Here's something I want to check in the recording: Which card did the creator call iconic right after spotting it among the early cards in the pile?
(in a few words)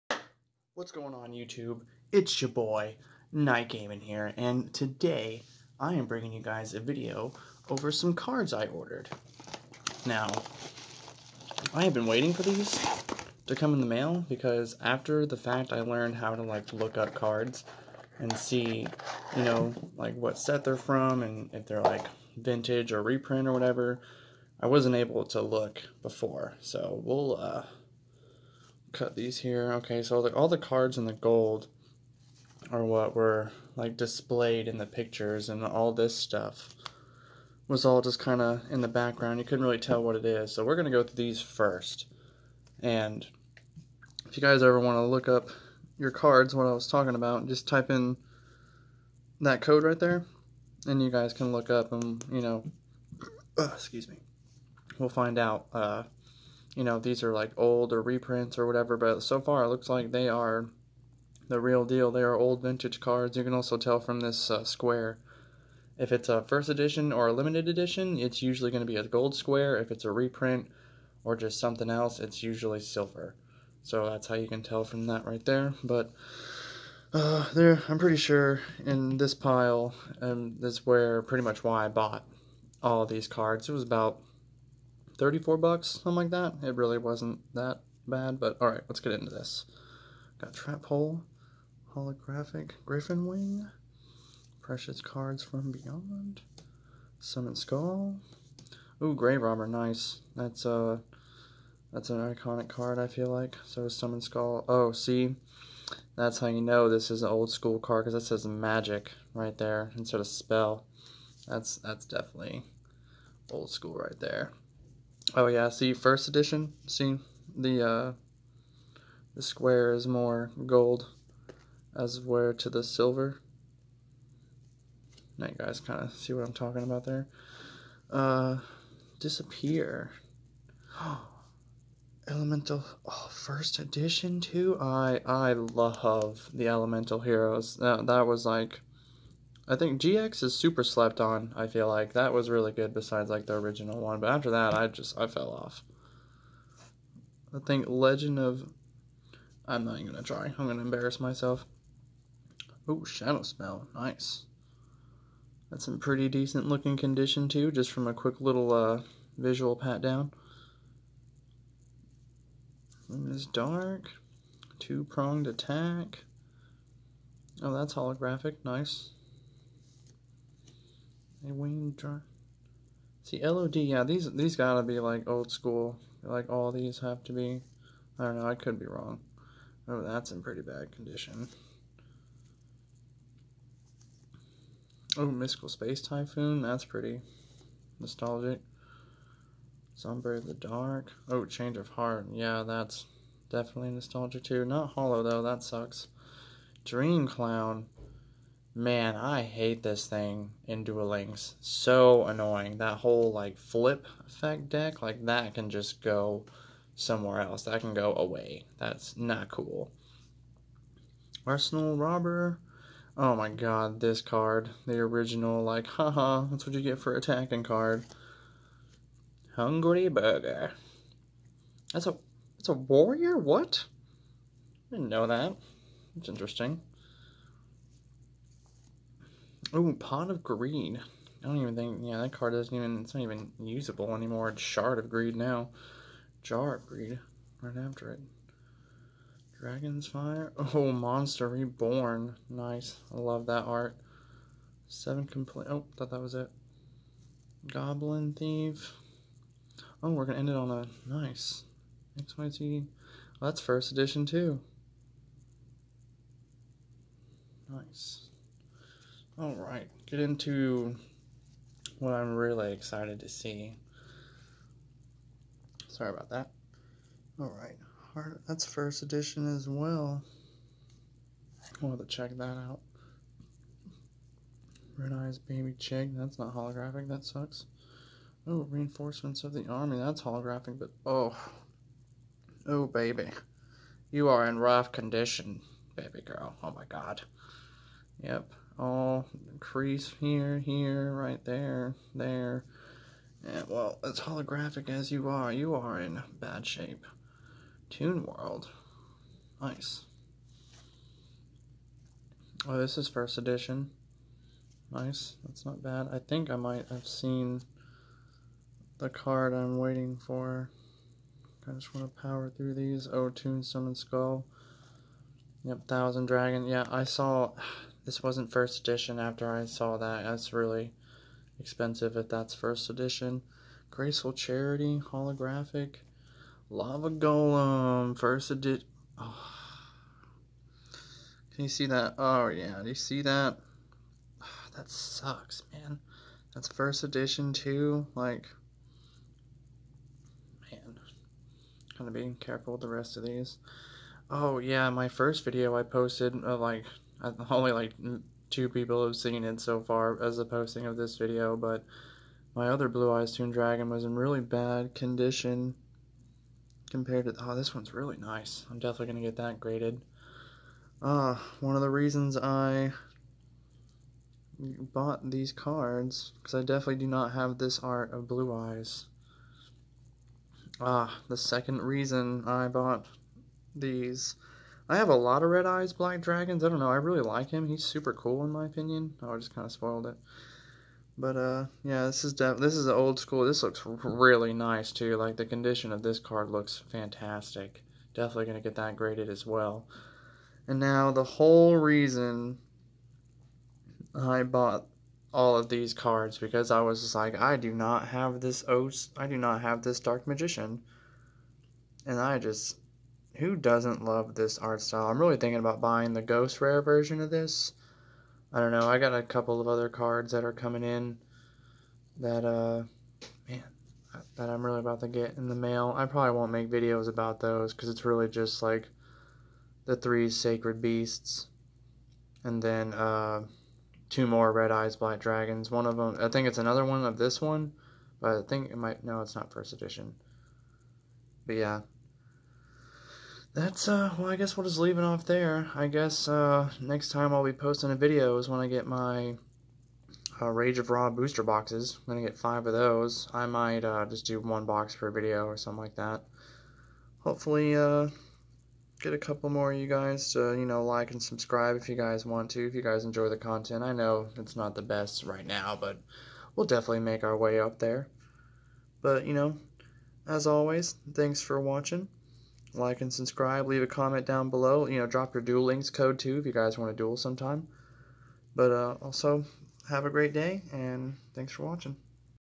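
Grave Robber.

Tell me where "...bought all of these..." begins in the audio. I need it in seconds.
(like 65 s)
394 s.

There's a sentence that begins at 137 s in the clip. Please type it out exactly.
that was like I think GX is super slept on, I feel like.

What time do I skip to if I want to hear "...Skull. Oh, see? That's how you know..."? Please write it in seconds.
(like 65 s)
104 s.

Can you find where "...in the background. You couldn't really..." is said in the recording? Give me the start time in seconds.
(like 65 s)
38 s.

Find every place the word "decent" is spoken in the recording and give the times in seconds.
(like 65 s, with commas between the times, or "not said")
156 s.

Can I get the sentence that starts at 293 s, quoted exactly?
And well, as holographic as you are, you are in bad shape.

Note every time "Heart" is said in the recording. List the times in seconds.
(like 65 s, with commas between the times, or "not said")
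191 s, 268 s.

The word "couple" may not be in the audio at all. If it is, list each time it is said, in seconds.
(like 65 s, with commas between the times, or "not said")
409 s, 449 s.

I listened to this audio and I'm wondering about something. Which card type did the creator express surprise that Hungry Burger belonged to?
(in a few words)
Warrior.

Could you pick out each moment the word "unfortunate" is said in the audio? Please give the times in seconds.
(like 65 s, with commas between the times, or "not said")
not said.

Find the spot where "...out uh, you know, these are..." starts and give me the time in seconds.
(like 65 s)
55 s.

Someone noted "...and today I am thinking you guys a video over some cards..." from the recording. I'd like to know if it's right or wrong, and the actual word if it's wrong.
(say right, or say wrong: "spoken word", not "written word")
wrong: "bringing", not "thinking".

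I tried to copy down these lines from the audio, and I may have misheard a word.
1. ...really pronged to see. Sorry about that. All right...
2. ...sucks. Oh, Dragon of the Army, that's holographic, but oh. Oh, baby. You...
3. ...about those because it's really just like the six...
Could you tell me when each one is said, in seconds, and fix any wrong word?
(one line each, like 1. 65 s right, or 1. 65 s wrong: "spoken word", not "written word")
1. 262 s wrong: "excited", not "pronged"
2. 277 s wrong: "Reinforcements", not "Dragon"
3. 417 s wrong: "three", not "six".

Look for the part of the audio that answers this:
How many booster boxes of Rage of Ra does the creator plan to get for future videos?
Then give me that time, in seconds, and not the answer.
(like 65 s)
442 s.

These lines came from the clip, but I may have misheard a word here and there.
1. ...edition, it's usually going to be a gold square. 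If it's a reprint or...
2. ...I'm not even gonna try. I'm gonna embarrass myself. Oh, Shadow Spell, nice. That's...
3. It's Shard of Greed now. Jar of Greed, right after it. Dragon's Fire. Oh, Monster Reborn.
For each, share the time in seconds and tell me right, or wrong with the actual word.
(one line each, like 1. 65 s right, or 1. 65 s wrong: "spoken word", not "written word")
1. 67 s right
2. 149 s right
3. 234 s right.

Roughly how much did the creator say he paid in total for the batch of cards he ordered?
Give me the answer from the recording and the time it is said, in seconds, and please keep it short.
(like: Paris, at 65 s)
$34, at 85 s.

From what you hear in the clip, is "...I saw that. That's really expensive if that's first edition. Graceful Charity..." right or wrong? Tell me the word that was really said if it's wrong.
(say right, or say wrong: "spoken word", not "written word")
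right.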